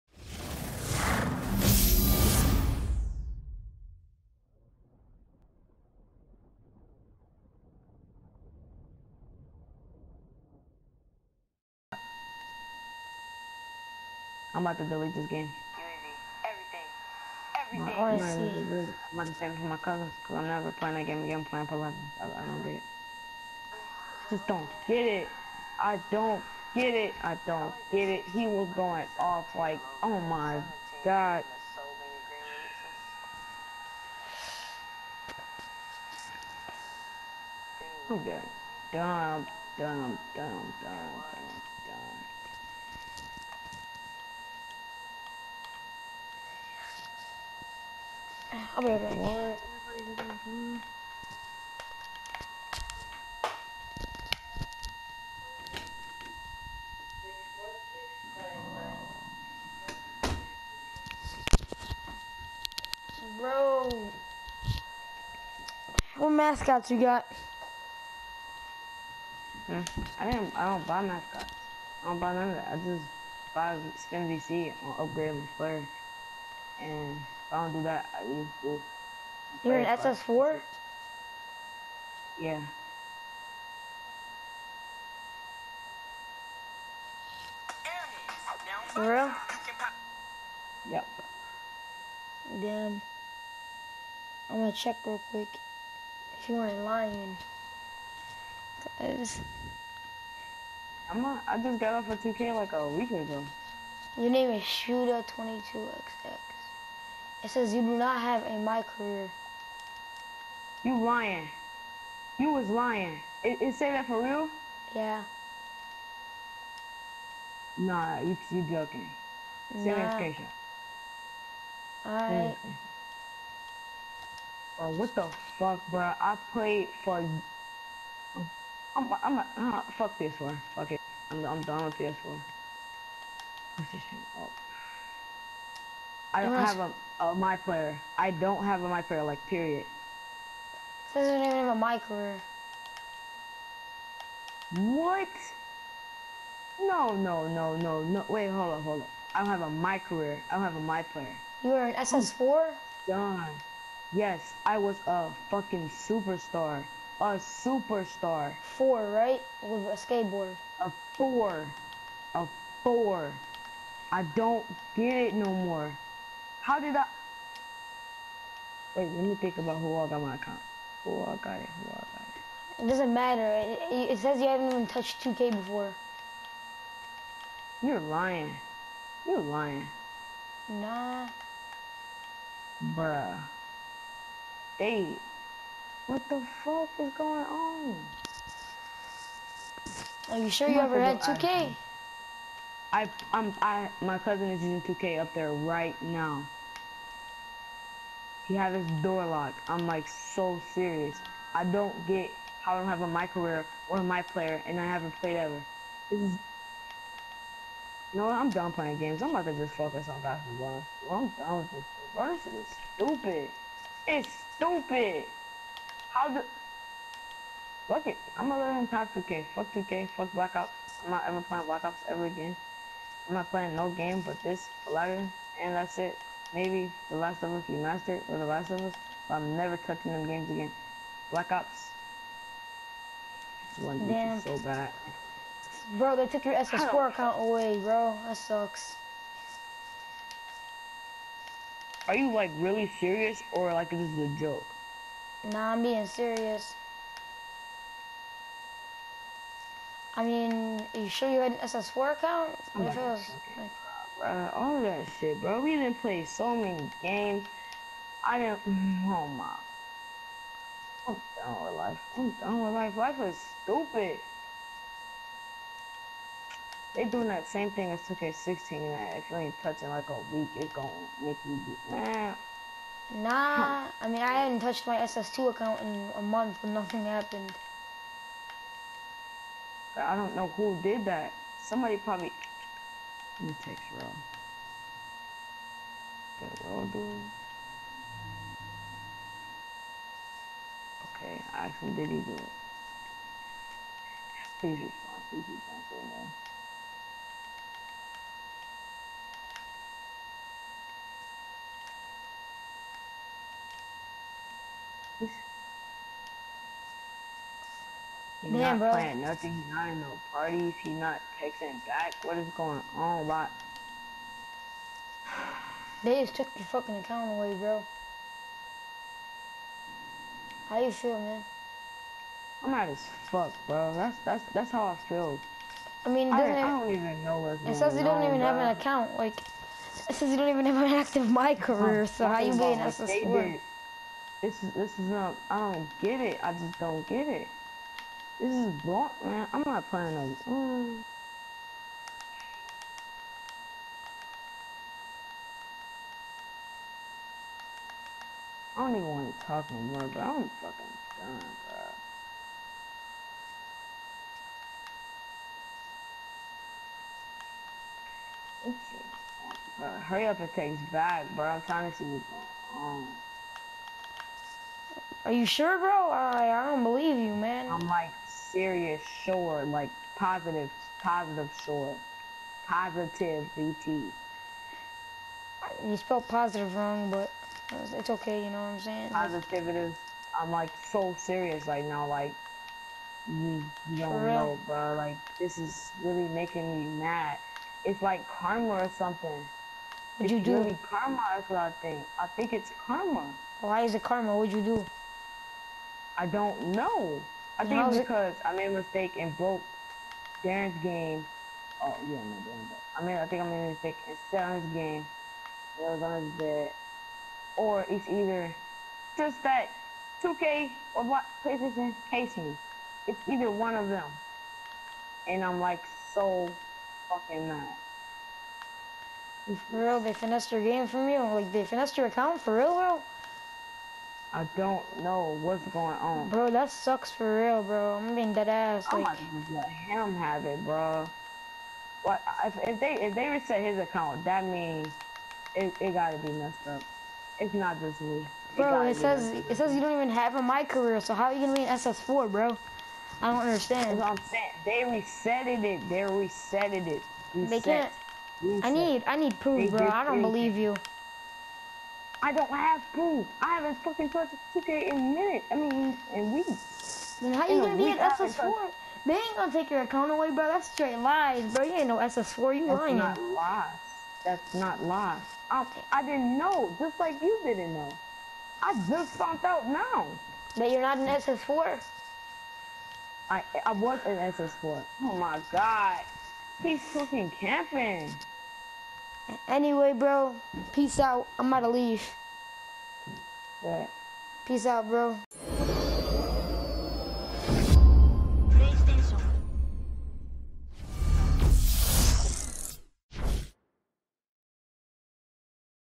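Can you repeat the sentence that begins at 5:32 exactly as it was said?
So how you being as a sport?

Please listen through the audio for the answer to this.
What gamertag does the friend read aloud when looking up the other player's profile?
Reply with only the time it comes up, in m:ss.
1:44.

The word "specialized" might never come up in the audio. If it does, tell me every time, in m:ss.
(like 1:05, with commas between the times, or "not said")
not said.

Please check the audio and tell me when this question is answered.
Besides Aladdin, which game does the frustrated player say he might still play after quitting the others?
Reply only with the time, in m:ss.
3:47.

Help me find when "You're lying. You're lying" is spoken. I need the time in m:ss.
2:57.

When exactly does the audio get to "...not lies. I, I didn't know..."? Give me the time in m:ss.
7:44.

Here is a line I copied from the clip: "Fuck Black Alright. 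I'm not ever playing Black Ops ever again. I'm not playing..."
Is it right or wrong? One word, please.
wrong.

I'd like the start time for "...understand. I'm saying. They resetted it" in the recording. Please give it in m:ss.
7:23.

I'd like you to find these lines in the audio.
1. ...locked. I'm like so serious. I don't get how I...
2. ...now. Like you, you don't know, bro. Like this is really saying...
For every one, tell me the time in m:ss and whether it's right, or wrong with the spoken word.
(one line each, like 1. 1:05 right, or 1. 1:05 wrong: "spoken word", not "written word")
1. 3:19 right
2. 6:21 wrong: "making", not "saying".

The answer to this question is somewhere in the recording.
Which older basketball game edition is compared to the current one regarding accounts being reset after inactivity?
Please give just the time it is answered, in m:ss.
4:28.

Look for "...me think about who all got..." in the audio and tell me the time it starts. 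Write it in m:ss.
2:49.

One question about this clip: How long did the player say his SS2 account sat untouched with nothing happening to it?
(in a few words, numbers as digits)
a month.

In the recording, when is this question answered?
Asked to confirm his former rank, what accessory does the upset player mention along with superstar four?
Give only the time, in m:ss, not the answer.
2:39.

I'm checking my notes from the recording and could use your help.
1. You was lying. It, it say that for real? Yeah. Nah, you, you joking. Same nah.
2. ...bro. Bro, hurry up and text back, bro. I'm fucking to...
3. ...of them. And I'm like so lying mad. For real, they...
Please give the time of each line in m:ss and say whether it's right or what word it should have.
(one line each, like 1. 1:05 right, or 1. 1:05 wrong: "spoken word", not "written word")
1. 1:52 right
2. 5:58 wrong: "trying", not "fucking"
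3. 6:53 wrong: "fucking", not "lying".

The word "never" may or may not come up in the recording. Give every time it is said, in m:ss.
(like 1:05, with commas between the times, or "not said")
0:20, 3:49.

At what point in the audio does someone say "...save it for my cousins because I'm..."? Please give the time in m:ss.
0:19.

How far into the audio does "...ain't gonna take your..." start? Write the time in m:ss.
7:39.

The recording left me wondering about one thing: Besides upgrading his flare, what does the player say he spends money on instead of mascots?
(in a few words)
skin VC.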